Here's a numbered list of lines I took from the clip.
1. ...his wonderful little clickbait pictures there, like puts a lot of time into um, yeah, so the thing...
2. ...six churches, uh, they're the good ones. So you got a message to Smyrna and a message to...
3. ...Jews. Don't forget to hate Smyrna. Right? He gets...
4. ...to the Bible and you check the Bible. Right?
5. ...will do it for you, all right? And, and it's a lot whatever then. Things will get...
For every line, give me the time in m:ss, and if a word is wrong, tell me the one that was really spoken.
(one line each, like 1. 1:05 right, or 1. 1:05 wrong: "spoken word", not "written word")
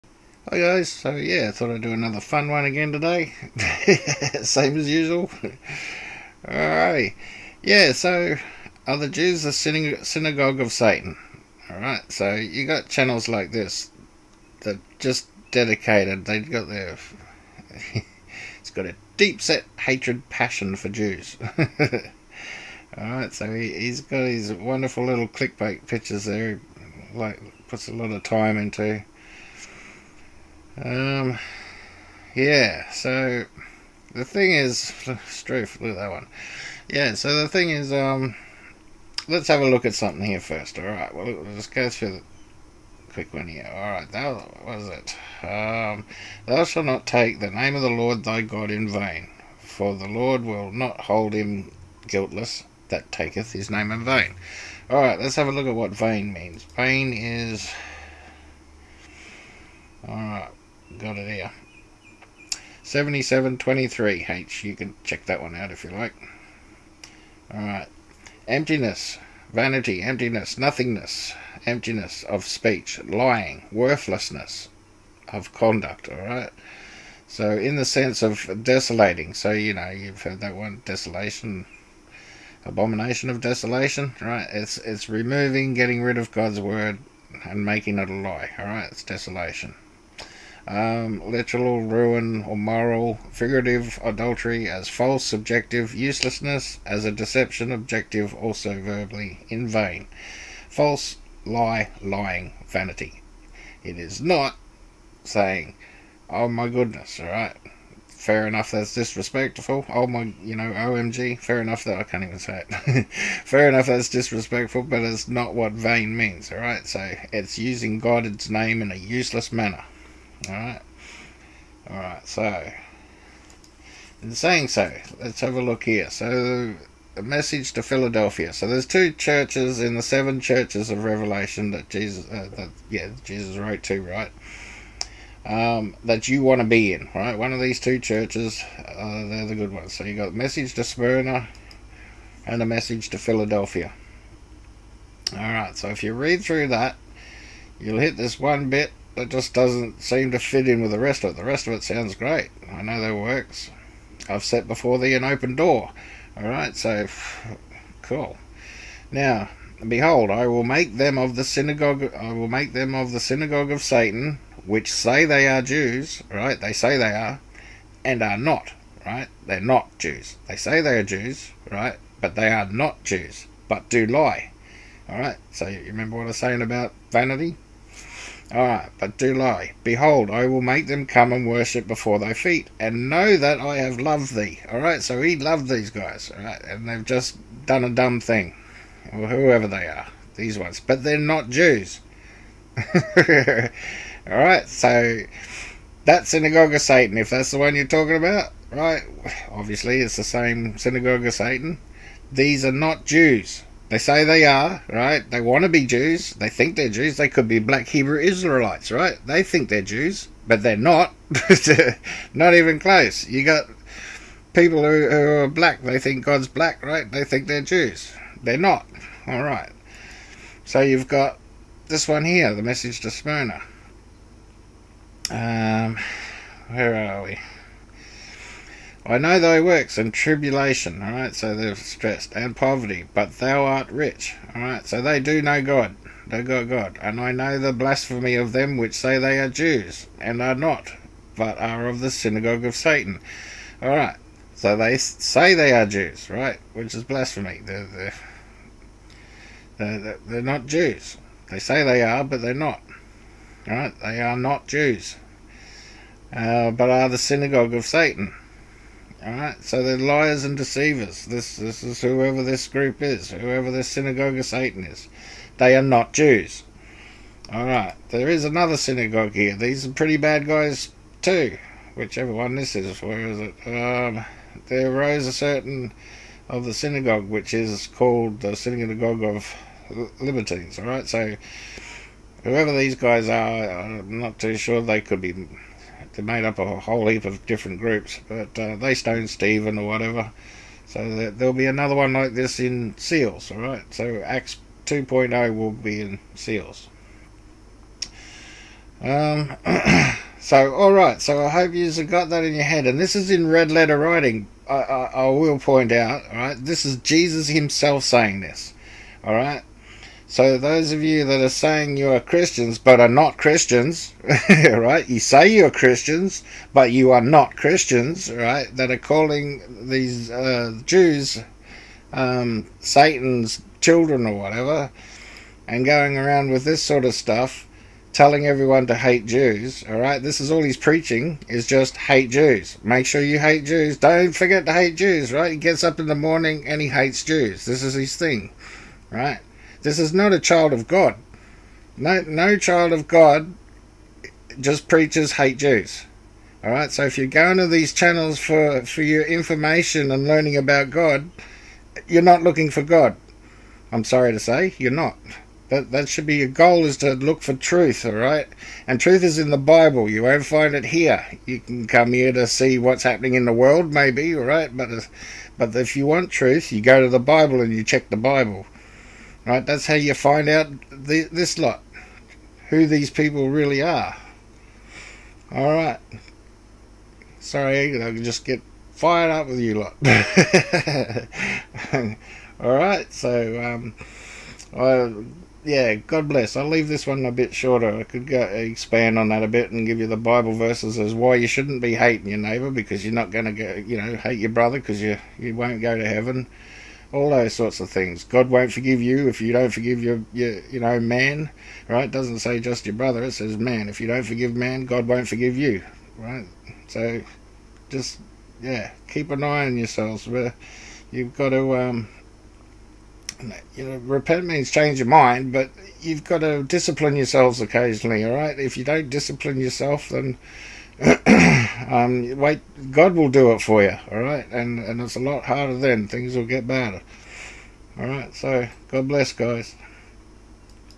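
1. 0:24 right
2. 2:17 wrong: "two", not "six"
3. 5:33 wrong: "Jews", not "Smyrna"
4. 6:07 right
5. 7:03 wrong: "harder", not "whatever".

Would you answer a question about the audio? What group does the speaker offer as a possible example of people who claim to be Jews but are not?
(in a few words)
Black Hebrew Israelites.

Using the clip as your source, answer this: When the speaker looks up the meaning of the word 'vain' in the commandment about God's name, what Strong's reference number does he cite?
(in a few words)
7723H.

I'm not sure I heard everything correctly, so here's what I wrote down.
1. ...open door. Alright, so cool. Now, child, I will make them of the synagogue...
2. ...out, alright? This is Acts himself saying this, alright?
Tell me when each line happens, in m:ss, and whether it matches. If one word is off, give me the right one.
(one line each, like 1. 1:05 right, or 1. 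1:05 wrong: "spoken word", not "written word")
1. 2:35 wrong: "behold", not "child"
2. 5:05 wrong: "Jesus", not "Acts".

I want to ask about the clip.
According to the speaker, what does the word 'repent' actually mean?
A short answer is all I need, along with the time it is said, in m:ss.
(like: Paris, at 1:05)
Change your mind, at 6:54.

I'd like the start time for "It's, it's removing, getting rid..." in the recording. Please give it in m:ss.
1:24.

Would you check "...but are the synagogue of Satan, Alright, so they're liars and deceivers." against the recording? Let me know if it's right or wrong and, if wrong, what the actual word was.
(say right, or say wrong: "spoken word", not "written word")
right.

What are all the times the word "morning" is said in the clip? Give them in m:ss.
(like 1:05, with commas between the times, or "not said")
5:36.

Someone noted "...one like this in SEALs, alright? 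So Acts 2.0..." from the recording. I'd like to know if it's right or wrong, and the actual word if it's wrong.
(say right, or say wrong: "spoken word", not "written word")
right.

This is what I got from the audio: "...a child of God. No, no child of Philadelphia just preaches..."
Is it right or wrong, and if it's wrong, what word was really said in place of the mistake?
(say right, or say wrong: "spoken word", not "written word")
wrong: "God", not "Philadelphia".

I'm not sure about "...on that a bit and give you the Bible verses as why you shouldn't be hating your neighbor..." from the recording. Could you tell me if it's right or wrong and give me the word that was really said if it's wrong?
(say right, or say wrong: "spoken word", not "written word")
right.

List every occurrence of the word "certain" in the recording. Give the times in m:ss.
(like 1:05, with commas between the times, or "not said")
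4:35.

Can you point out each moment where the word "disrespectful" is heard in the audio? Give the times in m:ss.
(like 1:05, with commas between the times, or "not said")
1:48, 1:54.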